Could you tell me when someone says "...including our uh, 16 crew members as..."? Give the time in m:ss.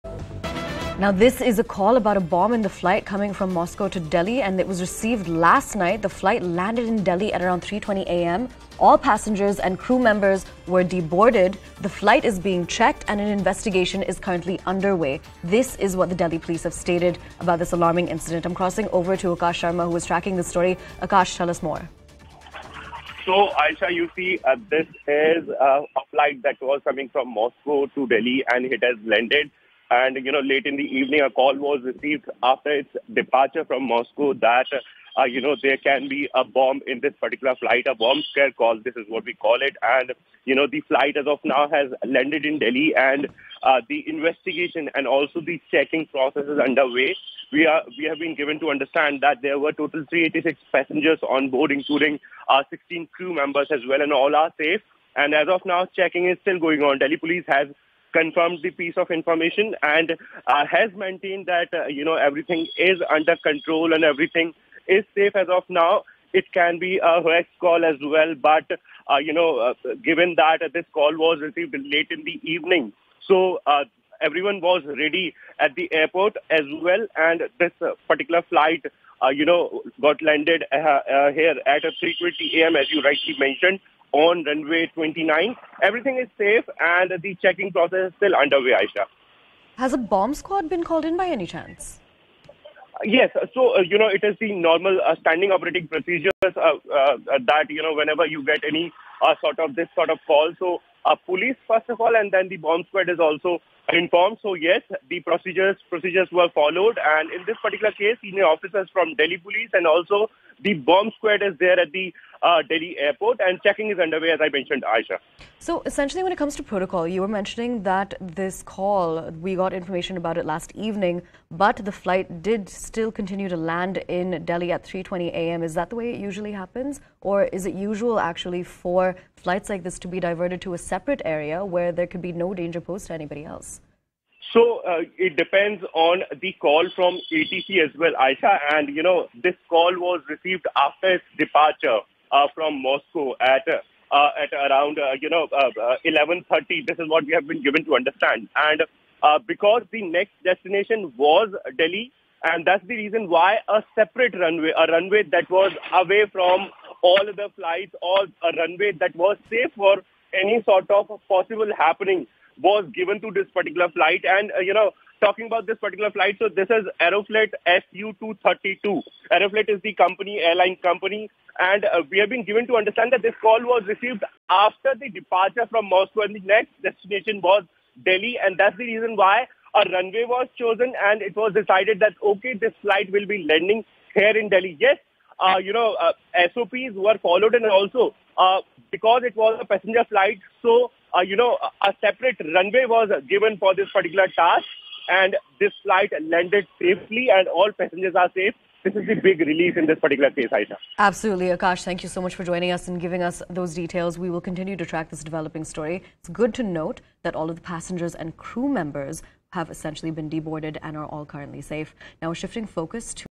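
0:51.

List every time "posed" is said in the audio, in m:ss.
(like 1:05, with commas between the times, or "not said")
2:12.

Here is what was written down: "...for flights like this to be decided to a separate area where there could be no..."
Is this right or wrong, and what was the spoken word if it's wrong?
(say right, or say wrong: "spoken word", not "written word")
wrong: "diverted", not "decided".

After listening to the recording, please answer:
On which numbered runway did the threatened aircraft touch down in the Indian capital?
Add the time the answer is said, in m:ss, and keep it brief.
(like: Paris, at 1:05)
29, at 1:24.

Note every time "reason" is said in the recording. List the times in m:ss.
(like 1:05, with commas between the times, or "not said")
2:32, 2:58.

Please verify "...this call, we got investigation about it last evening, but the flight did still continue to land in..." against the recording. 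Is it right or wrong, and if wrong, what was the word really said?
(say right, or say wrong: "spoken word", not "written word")
wrong: "information", not "investigation".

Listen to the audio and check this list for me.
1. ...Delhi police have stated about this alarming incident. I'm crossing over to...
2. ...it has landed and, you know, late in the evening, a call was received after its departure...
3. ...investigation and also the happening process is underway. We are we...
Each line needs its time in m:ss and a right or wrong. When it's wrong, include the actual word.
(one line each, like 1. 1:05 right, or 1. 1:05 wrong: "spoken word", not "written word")
1. 0:16 right
2. 0:28 right
3. 0:44 wrong: "checking", not "happening".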